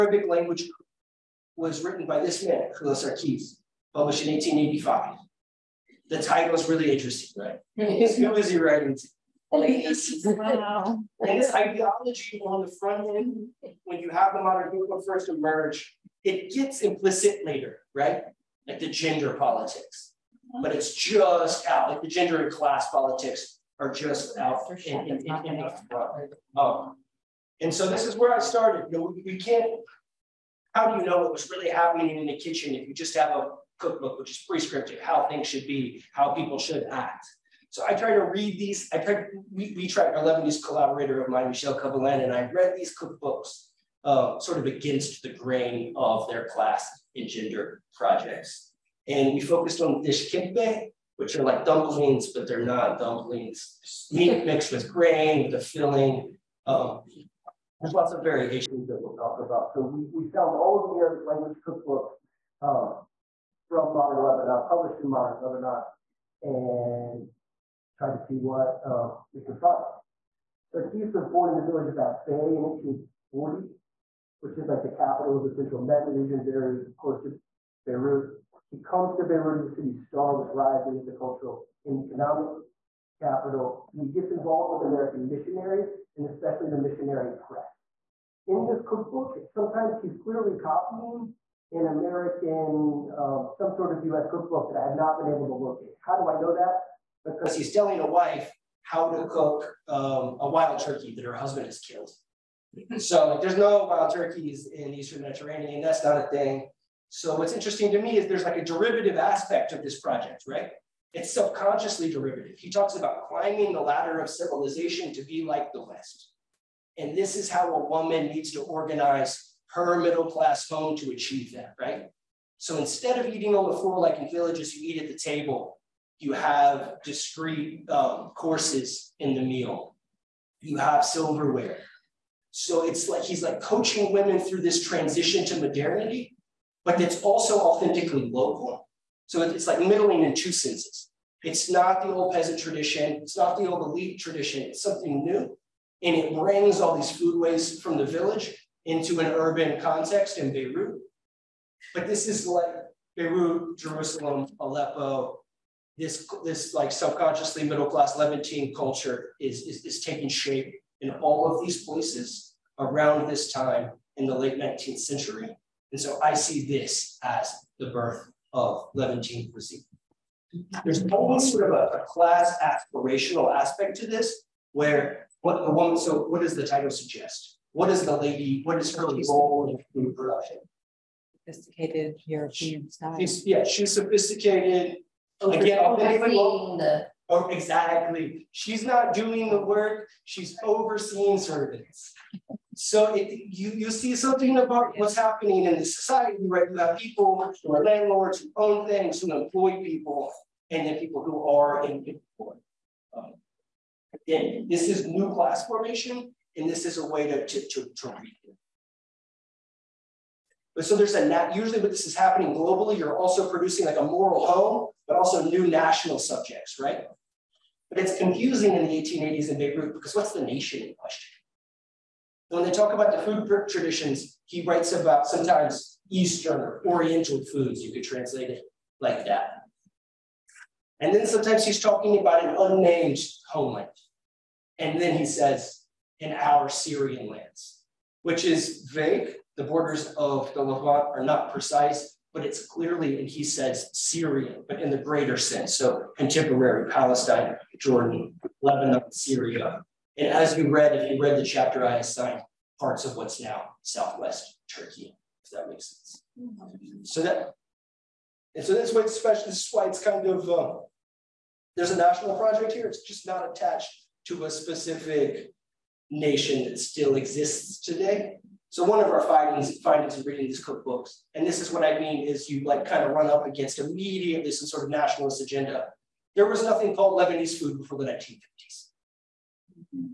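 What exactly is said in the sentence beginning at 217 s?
But it's confusing in the 1880s in Beirut because what's the nation in question?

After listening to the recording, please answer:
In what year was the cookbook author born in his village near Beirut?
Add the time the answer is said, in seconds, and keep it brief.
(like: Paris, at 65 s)
1840, at 72 s.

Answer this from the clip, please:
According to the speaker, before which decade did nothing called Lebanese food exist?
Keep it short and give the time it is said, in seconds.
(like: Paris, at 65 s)
1950s, at 278 s.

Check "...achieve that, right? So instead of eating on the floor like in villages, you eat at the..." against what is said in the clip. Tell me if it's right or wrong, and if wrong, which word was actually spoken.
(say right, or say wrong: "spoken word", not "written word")
right.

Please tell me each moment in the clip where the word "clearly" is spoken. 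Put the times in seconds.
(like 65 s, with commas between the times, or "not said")
90 s, 242 s.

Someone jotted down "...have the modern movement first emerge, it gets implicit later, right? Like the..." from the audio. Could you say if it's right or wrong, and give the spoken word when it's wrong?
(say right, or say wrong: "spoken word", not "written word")
right.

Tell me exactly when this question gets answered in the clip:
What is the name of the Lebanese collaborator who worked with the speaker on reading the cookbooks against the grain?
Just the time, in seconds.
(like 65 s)
41 s.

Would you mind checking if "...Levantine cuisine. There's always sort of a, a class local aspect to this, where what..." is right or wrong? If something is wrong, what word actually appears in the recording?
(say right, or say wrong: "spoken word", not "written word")
wrong: "aspirational", not "local".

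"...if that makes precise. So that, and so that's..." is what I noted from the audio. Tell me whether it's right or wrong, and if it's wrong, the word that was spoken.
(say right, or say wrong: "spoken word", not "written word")
wrong: "sense", not "precise".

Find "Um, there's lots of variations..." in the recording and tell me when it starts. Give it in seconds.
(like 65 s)
56 s.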